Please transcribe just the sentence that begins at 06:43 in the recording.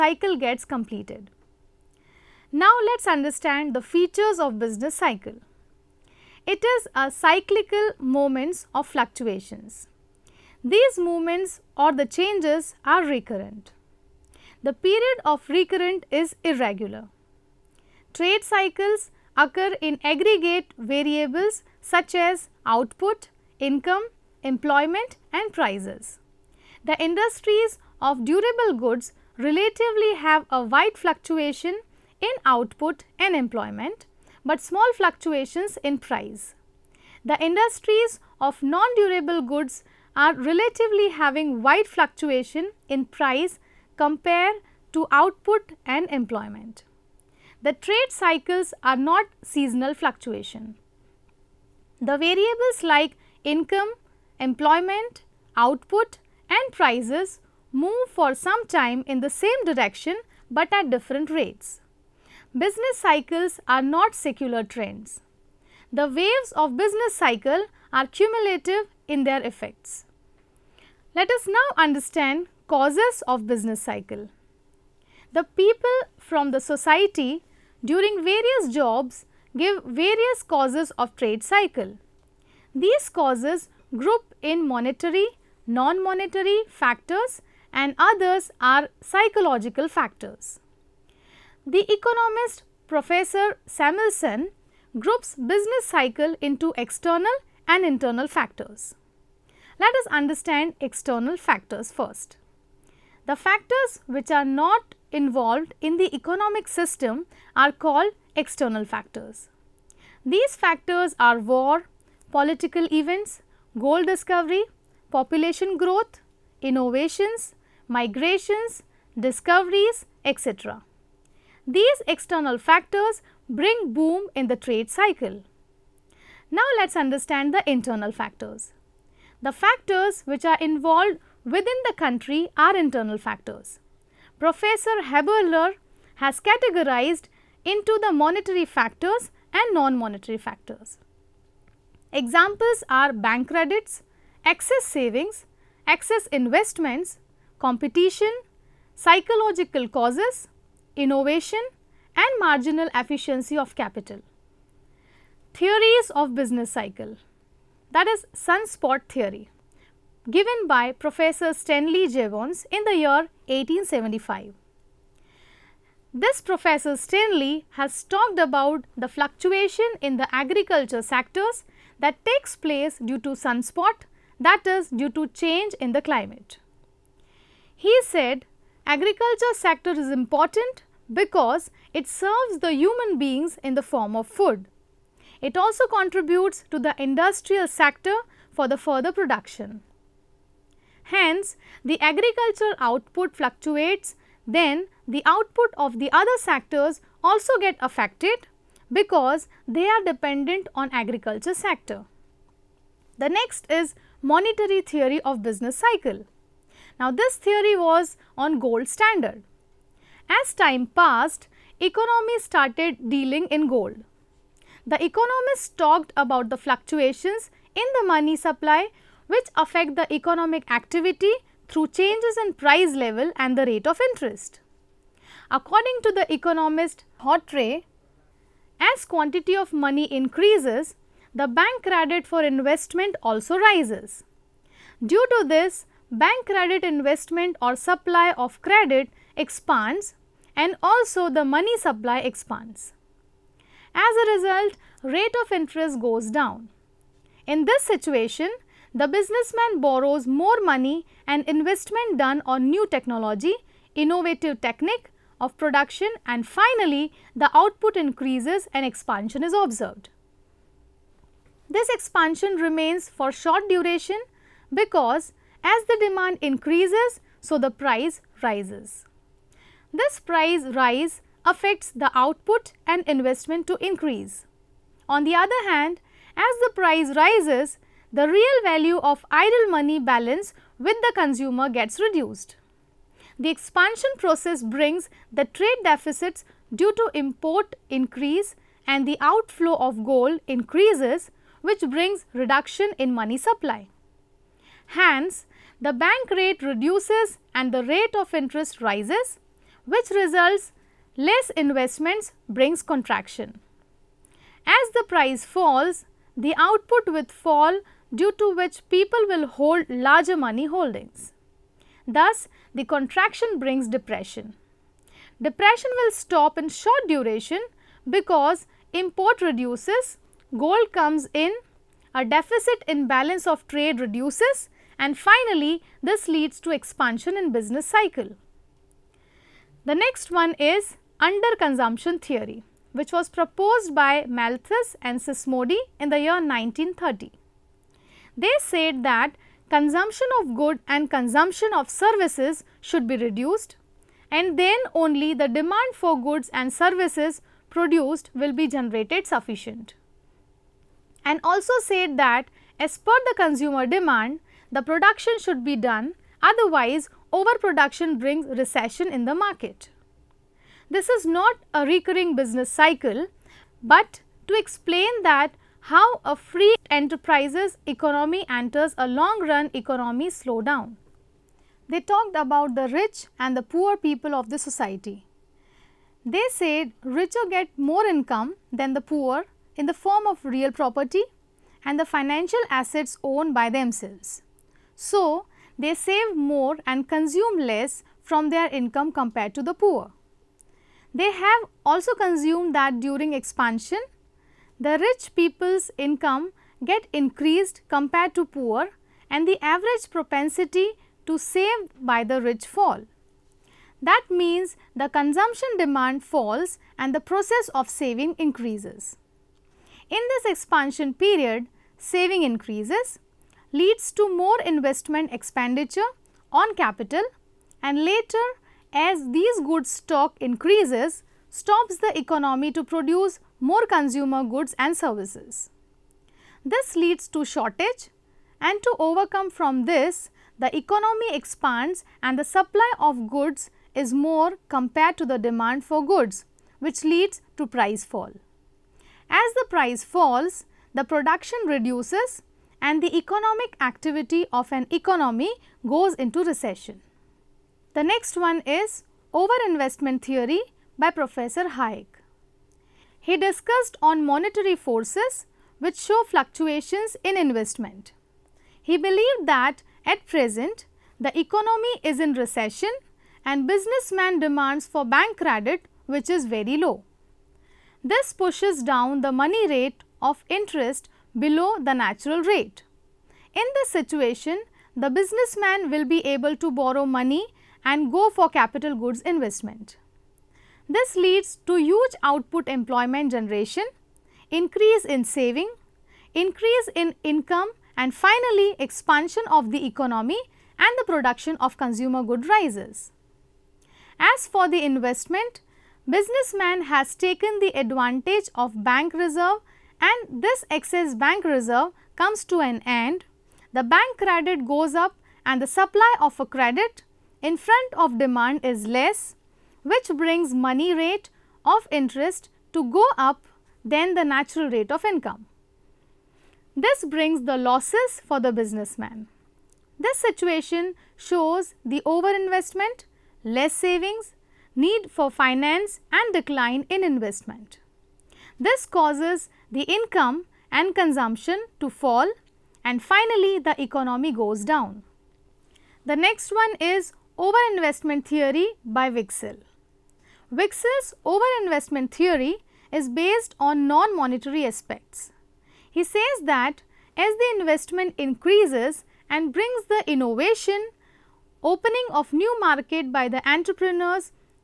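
That means the consumption demand falls and the process of saving increases.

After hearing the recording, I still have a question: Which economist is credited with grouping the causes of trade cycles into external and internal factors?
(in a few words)
Samuelson.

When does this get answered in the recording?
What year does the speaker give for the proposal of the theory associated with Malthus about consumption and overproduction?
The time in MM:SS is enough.
05:36.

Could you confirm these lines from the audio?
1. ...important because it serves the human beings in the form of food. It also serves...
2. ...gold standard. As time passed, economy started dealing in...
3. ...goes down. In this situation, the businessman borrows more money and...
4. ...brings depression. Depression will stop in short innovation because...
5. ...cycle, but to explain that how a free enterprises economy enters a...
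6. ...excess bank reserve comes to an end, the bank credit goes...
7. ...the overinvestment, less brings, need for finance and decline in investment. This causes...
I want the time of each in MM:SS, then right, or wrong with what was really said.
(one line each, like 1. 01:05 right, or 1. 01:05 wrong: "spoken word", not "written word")
1. 03:00 wrong: "contributes", not "serves"
2. 03:28 right
3. 04:05 right
4. 05:13 wrong: "duration", not "innovation"
5. 06:02 right
6. 08:20 right
7. 08:41 wrong: "savings", not "brings".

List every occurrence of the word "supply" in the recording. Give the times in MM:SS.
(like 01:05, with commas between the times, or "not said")
03:38, 03:57, 04:01, 04:53, 07:12, 08:25.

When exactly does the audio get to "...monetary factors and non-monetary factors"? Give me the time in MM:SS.
02:18.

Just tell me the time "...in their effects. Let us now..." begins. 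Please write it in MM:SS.
01:09.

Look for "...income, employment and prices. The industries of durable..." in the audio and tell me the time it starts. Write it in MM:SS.
00:23.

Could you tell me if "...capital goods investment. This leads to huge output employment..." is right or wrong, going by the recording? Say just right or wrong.
right.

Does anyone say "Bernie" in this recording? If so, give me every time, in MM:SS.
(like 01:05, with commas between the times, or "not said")
not said.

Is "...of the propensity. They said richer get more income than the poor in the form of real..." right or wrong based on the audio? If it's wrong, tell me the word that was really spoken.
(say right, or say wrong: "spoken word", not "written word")
wrong: "society", not "propensity".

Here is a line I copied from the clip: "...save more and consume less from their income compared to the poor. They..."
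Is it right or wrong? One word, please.
right.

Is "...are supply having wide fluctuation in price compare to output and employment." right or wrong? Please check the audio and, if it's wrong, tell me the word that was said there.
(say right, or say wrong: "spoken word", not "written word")
wrong: "relatively", not "supply".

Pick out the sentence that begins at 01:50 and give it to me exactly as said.
These factors are war, political events, gold discovery, population growth, innovations, migrations, discoveries, etc.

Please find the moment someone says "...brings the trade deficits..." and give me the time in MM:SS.
04:44.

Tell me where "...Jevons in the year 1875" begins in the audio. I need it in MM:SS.
02:42.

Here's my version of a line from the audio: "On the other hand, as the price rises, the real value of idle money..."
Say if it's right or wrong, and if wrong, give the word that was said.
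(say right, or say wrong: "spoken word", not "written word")
right.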